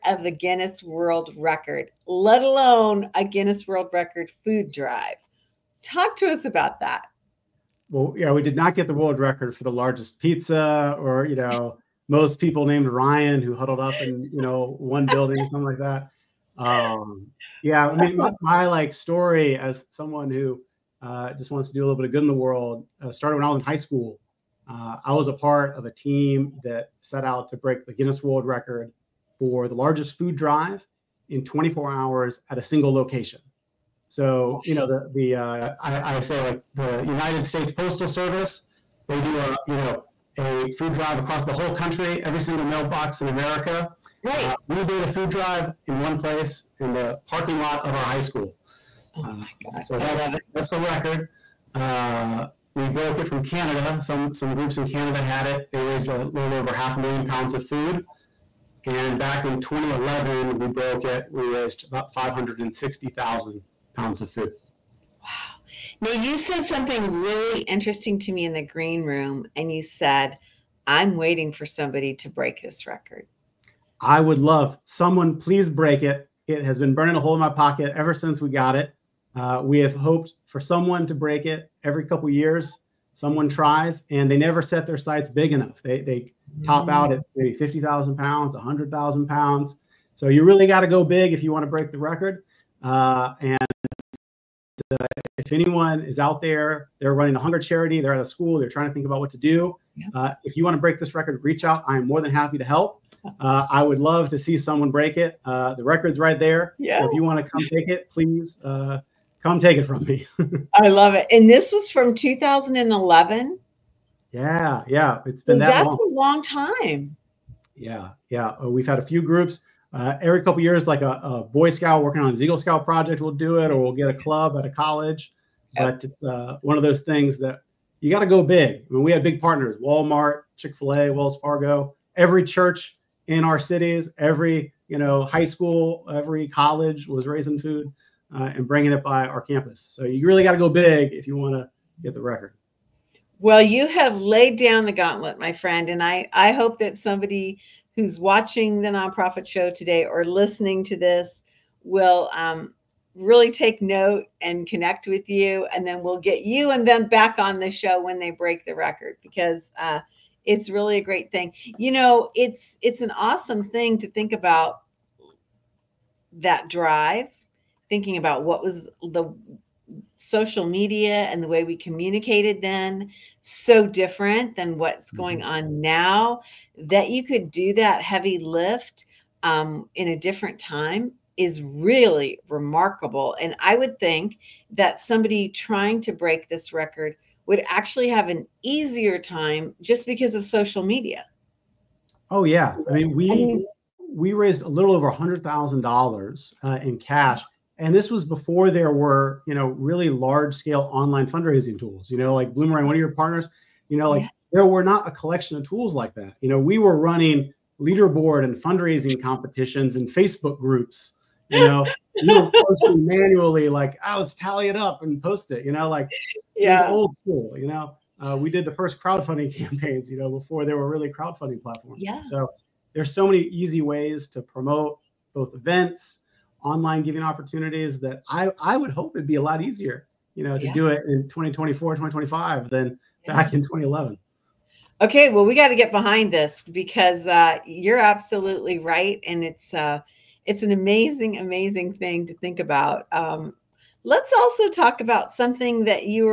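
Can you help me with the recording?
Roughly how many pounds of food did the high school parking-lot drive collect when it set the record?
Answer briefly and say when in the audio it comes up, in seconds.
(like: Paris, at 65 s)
560,000 pounds, at 61 s.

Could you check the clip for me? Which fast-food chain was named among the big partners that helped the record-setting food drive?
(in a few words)
Chick Fil A.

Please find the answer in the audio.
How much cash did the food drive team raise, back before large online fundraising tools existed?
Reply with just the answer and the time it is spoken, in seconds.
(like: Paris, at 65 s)
$100,000, at 194 s.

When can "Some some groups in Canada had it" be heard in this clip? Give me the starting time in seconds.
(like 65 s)
54 s.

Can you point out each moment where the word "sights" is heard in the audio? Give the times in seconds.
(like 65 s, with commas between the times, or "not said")
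84 s.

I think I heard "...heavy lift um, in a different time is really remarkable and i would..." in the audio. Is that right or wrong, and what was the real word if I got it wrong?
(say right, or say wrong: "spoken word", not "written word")
right.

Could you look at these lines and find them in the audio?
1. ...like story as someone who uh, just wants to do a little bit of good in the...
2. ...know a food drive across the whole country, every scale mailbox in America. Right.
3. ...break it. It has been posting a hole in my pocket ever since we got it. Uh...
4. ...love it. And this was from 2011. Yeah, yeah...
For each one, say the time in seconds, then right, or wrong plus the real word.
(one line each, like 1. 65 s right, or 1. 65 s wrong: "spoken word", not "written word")
1. 18 s right
2. 39 s wrong: "single", not "scale"
3. 75 s wrong: "burning", not "posting"
4. 110 s right.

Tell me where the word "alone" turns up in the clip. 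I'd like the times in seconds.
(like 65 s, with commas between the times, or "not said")
2 s.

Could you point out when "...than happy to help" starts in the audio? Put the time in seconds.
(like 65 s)
102 s.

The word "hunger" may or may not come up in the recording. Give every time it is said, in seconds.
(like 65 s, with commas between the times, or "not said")
97 s.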